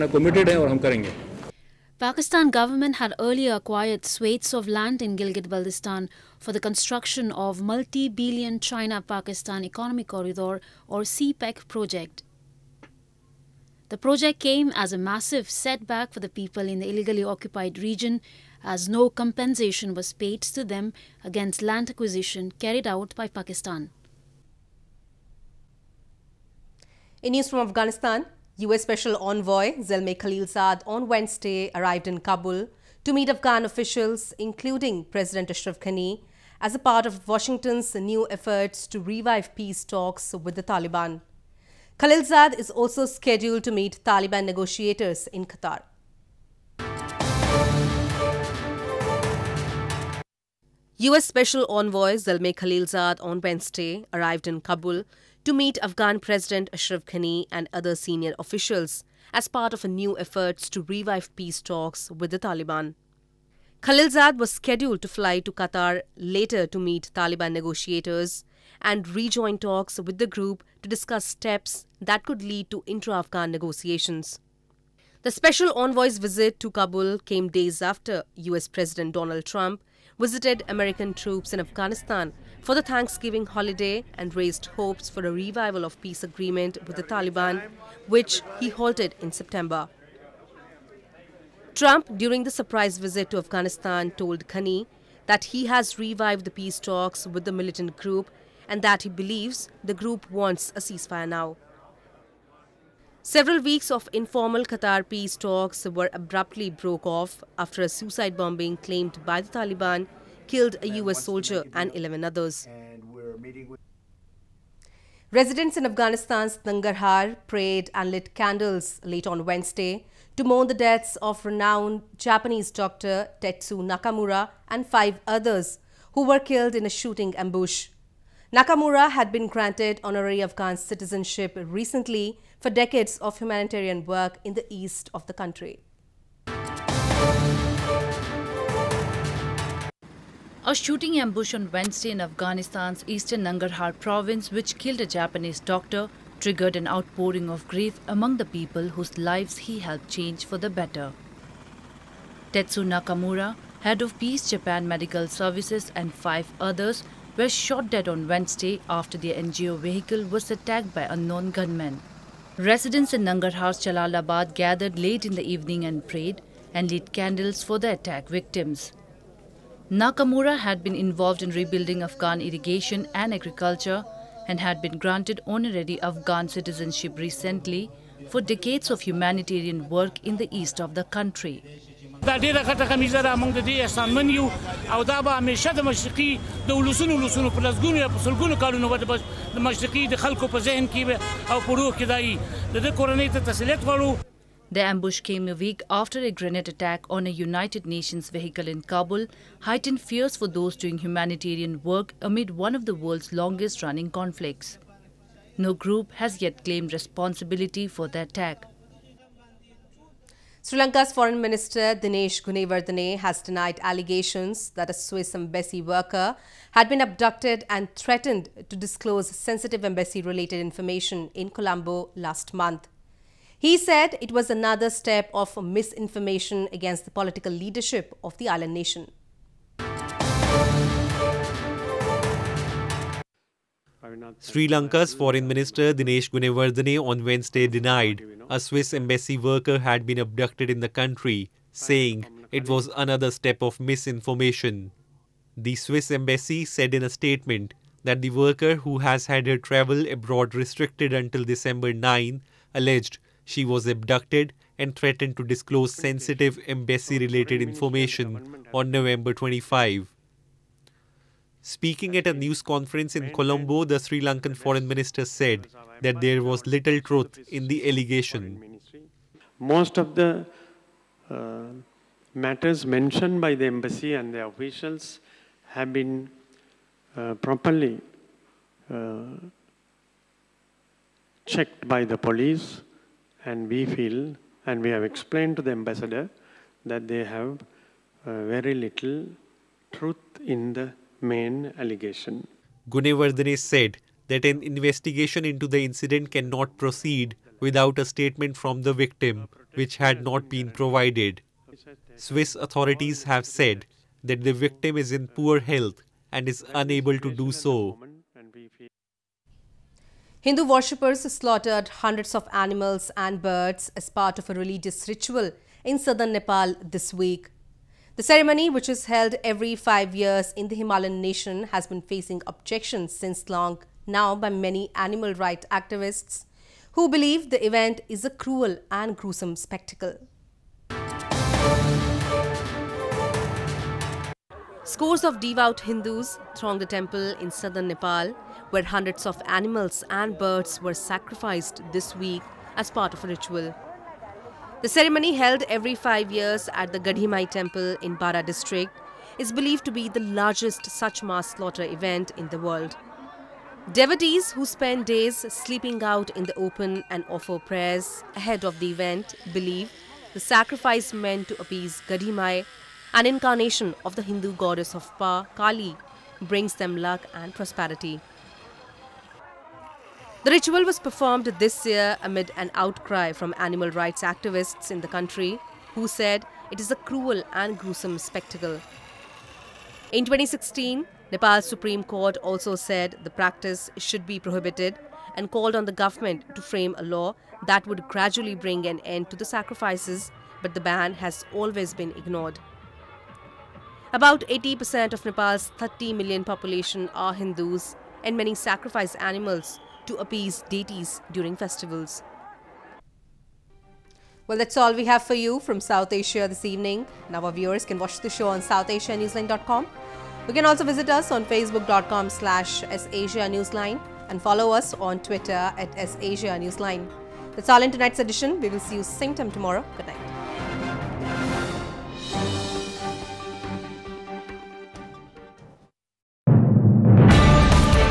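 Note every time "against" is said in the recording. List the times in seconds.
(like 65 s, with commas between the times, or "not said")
21 s, 226 s.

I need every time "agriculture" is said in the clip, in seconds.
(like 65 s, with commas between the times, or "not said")
173 s.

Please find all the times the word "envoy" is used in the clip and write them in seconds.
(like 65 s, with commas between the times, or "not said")
29 s, 51 s, 75 s.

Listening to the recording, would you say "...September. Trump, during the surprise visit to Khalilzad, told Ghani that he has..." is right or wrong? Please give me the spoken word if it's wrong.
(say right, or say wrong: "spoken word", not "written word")
wrong: "Afghanistan", not "Khalilzad".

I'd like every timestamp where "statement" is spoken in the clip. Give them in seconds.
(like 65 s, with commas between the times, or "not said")
247 s, 298 s.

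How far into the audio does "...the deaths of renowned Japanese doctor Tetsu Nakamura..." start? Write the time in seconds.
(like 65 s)
120 s.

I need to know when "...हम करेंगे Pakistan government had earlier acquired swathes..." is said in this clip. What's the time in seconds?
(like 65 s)
0 s.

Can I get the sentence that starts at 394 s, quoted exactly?
About 80% of Nepal's 30 million population are Hindus, and many sacrifice animals to appease deities during festivals.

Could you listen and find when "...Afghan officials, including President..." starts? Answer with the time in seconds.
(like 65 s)
33 s.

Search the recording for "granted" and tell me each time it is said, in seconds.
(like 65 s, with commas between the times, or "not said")
129 s, 174 s.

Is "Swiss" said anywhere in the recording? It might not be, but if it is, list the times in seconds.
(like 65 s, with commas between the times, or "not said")
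214 s, 238 s, 245 s, 302 s.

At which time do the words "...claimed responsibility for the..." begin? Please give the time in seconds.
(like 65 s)
206 s.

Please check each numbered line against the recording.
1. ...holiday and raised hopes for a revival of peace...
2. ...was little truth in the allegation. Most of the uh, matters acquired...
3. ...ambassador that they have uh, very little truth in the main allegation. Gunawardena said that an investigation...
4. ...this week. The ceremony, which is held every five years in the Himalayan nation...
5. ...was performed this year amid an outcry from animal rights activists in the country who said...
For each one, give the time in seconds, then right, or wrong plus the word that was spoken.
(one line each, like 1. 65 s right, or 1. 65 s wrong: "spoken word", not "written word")
1. 83 s right
2. 266 s wrong: "mentioned", not "acquired"
3. 285 s right
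4. 316 s right
5. 370 s right.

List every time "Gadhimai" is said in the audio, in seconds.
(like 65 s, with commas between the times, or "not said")
347 s, 362 s.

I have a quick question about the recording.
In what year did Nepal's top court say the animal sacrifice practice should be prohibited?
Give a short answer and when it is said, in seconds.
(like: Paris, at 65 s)
2016, at 380 s.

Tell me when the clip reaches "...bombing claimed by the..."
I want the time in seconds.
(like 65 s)
108 s.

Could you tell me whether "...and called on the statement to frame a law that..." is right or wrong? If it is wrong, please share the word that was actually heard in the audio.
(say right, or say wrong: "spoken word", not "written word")
wrong: "government", not "statement".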